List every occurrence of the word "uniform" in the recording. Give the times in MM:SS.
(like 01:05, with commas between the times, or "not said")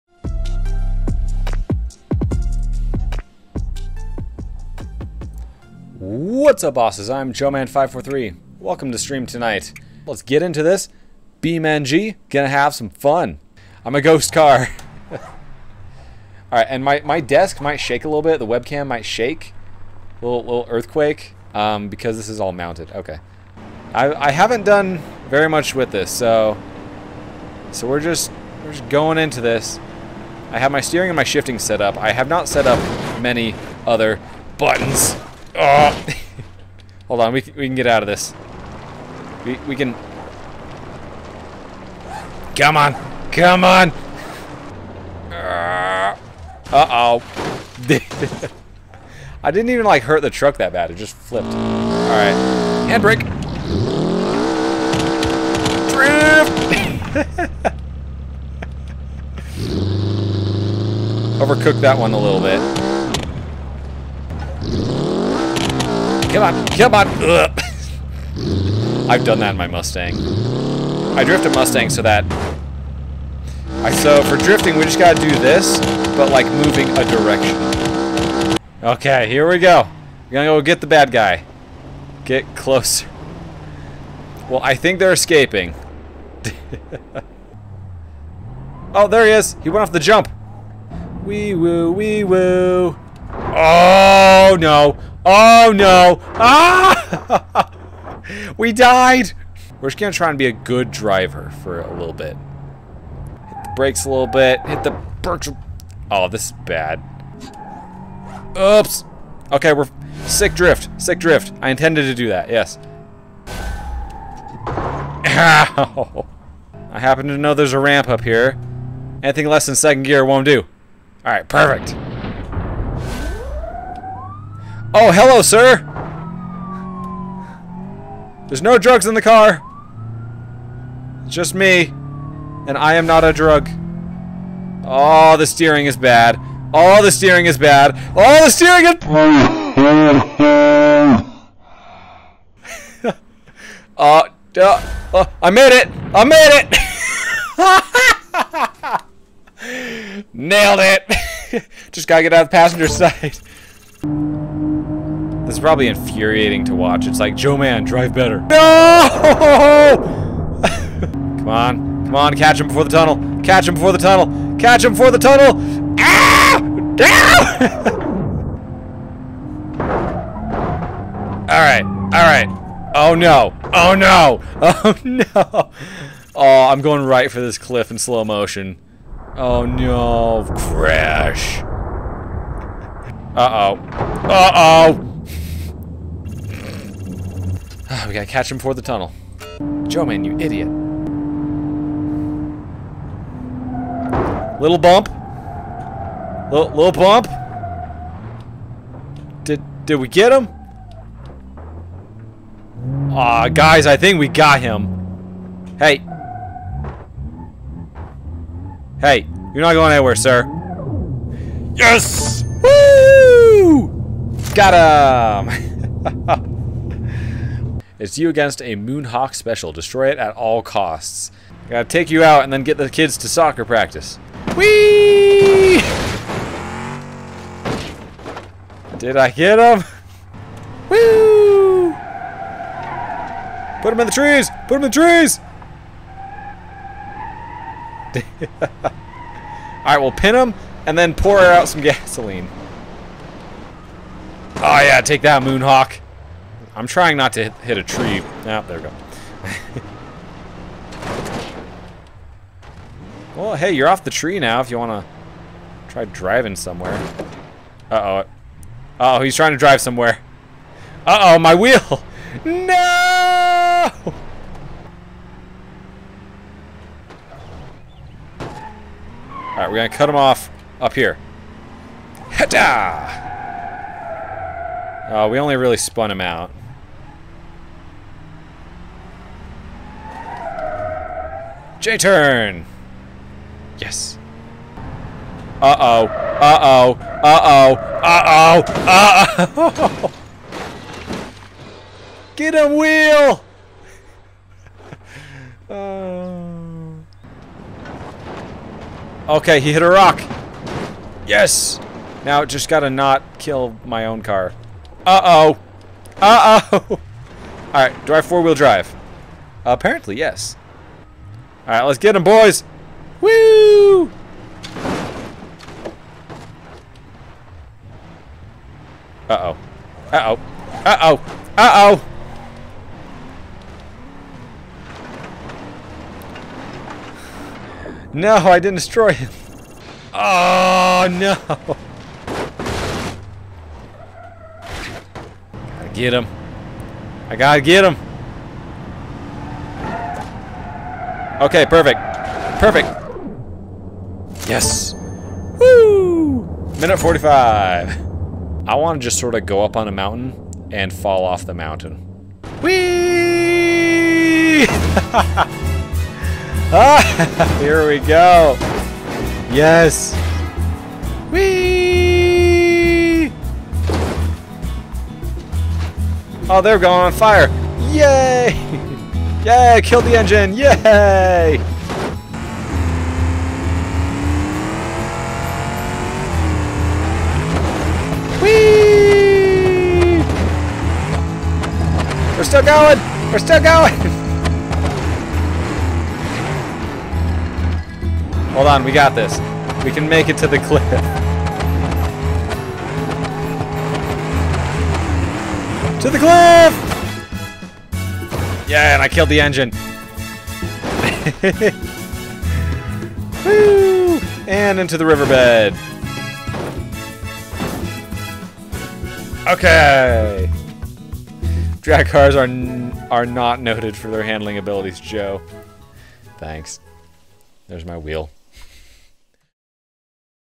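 not said.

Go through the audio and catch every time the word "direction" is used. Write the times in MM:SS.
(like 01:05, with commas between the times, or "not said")
01:17.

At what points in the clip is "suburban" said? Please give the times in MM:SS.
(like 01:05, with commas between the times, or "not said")
not said.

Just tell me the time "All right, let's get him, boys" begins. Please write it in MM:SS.
05:11.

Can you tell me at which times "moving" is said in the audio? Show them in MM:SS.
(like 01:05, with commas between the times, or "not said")
01:16.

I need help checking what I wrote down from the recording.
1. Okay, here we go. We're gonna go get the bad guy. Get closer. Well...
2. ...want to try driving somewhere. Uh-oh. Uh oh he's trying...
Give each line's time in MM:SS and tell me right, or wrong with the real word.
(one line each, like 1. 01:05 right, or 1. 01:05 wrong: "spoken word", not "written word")
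1. 01:18 right
2. 04:14 right.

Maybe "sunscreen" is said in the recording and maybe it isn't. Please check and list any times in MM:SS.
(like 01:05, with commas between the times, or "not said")
not said.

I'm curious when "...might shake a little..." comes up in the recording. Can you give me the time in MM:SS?
00:17.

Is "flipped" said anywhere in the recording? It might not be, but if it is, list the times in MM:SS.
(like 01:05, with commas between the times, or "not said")
00:51.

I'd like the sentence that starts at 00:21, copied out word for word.
Um, because this is all mounted.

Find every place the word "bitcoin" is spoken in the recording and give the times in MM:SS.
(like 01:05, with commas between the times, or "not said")
not said.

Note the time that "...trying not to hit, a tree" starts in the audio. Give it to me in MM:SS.
04:06.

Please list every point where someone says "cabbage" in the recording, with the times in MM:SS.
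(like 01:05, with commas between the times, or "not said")
not said.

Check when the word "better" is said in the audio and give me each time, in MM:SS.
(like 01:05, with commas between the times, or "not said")
02:38.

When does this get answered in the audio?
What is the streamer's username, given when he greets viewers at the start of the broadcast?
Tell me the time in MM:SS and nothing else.
00:07.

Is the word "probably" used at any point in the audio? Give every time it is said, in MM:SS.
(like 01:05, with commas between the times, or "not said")
02:35.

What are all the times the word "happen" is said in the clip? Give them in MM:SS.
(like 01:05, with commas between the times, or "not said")
01:56.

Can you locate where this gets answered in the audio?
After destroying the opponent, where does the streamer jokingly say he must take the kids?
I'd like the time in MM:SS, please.
03:43.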